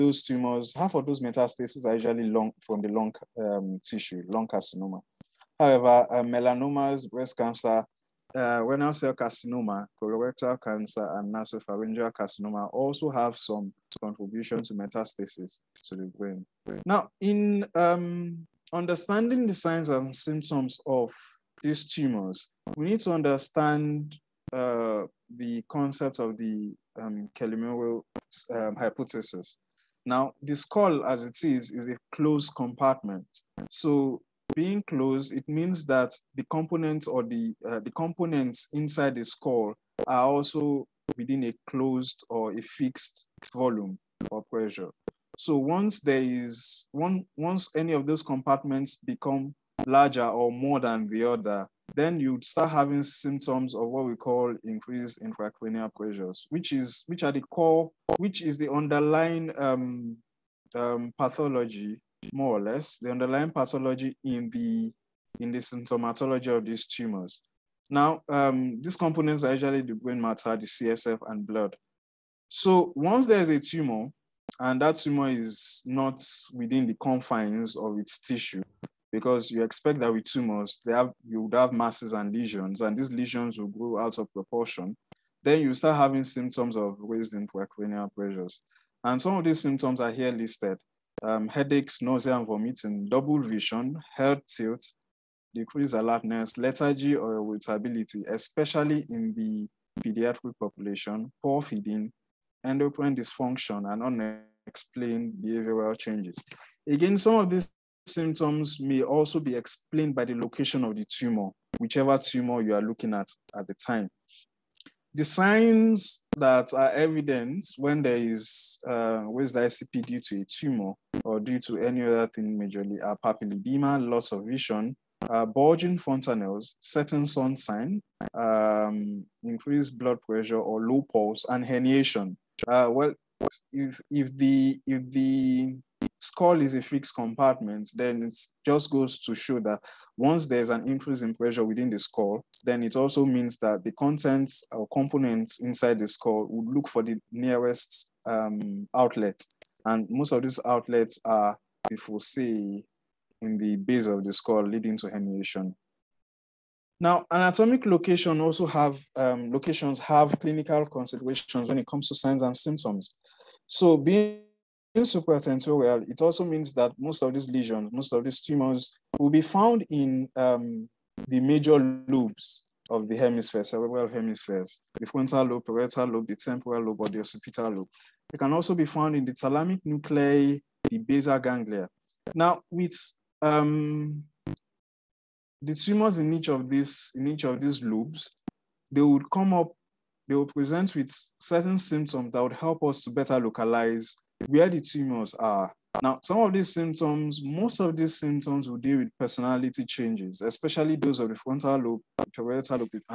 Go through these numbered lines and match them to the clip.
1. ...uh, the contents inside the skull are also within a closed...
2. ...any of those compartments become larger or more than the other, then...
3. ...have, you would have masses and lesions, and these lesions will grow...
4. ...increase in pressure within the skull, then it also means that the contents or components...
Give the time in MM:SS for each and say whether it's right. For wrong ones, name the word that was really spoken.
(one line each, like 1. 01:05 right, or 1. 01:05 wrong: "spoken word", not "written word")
1. 00:37 wrong: "components", not "contents"
2. 00:47 right
3. 01:20 right
4. 02:20 right.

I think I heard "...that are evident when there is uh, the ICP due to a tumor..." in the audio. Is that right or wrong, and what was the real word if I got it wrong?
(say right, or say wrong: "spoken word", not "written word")
right.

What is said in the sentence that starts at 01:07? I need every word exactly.
Now, um, these components are usually the brain matter, the CSF, and blood.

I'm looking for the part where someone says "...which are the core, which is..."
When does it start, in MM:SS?
00:57.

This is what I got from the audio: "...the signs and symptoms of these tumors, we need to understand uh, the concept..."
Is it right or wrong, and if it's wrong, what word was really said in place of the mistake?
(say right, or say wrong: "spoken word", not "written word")
right.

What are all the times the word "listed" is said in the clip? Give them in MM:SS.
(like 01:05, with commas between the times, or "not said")
01:30.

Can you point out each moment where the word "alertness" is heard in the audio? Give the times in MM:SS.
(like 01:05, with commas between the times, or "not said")
01:35.